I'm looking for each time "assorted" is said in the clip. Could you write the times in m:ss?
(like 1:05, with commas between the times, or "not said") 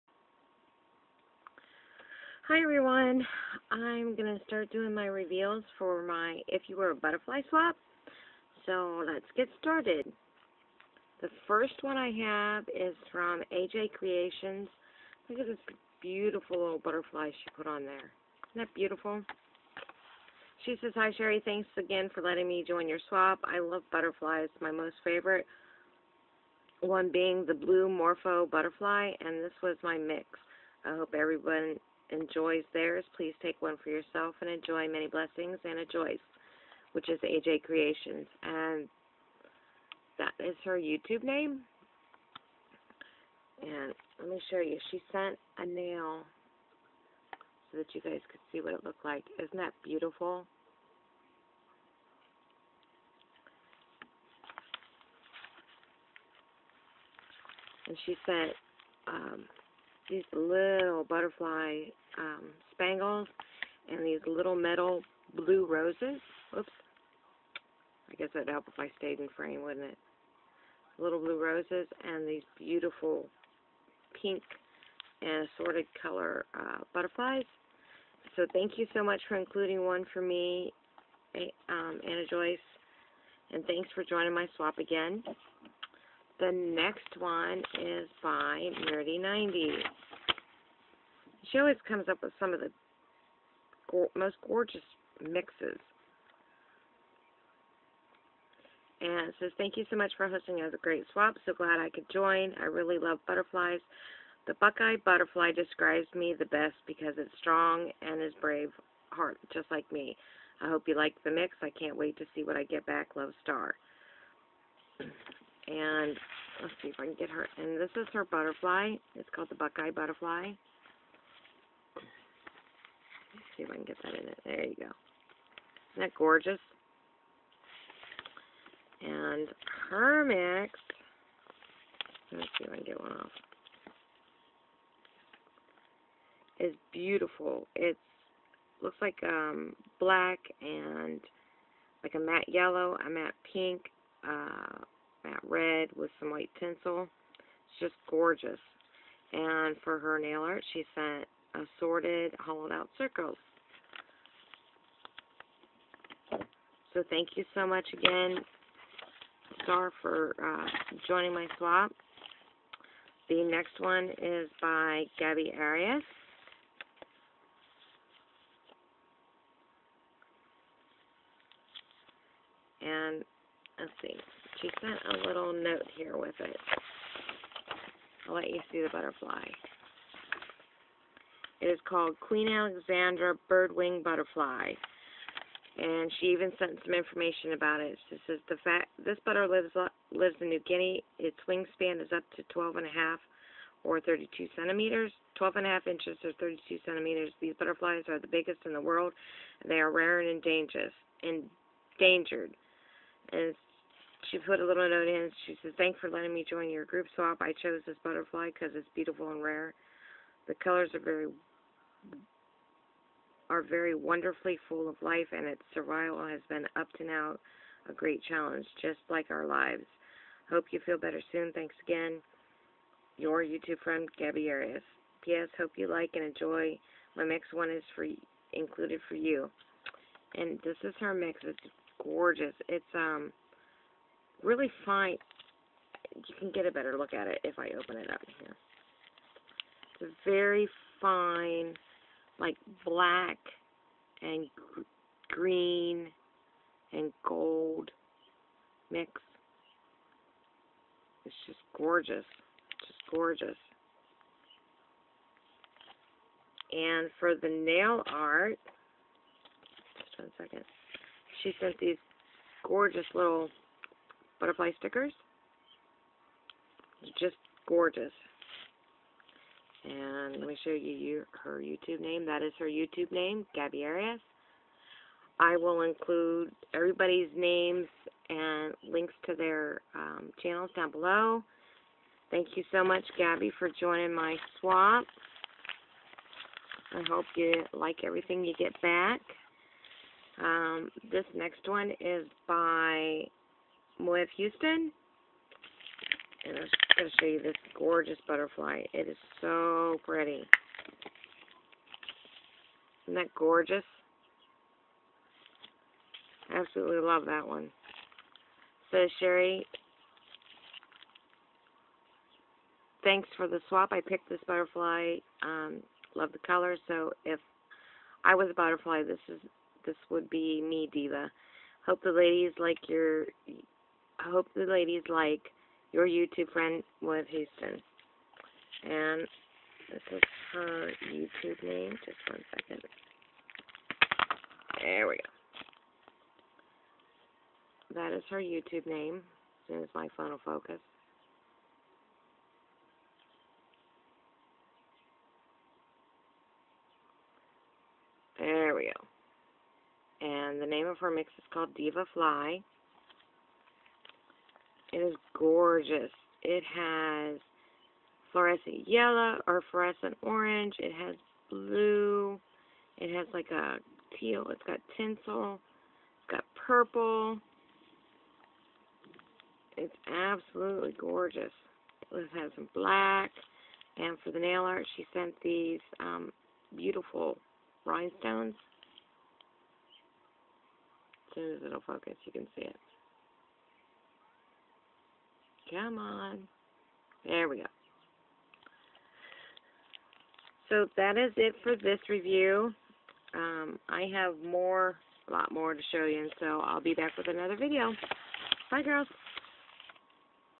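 1:15, 2:31.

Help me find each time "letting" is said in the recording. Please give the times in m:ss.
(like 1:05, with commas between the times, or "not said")
0:22, 3:26.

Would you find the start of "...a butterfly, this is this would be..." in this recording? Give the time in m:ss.
5:18.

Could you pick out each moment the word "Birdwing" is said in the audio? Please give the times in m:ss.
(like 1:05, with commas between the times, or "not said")
3:03.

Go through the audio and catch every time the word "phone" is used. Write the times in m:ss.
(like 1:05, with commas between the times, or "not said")
5:40.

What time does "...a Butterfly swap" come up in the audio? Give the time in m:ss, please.
0:06.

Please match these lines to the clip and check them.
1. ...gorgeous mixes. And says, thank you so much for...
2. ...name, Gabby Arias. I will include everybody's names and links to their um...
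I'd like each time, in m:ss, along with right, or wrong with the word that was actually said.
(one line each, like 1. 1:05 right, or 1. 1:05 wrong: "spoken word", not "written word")
1. 1:34 right
2. 4:33 right.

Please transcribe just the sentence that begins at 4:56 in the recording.
And I'm just going to show you this gorgeous butterfly.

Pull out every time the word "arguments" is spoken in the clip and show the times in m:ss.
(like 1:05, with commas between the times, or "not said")
not said.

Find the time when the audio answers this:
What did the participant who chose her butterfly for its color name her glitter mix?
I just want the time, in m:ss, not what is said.
5:51.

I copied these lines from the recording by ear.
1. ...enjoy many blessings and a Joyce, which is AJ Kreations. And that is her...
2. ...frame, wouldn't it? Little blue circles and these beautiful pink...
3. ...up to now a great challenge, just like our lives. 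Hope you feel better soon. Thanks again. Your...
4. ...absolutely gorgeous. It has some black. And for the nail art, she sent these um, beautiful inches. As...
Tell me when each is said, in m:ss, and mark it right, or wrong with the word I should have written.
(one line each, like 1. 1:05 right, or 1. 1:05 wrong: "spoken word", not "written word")
1. 0:34 right
2. 1:09 wrong: "roses", not "circles"
3. 3:36 right
4. 6:10 wrong: "rhinestones", not "inches".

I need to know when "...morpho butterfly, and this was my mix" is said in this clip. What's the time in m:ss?
0:27.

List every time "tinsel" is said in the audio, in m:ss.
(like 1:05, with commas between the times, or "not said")
2:26, 6:04.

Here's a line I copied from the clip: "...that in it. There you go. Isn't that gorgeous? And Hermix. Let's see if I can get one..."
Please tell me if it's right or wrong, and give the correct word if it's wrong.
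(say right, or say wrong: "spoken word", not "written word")
right.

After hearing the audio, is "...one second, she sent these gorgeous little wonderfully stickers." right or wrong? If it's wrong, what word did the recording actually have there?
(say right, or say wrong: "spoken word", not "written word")
wrong: "butterfly", not "wonderfully".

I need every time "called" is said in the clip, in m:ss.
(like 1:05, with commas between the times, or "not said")
1:59, 3:01, 5:51.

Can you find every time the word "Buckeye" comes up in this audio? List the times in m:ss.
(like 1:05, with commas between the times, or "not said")
1:44, 1:59.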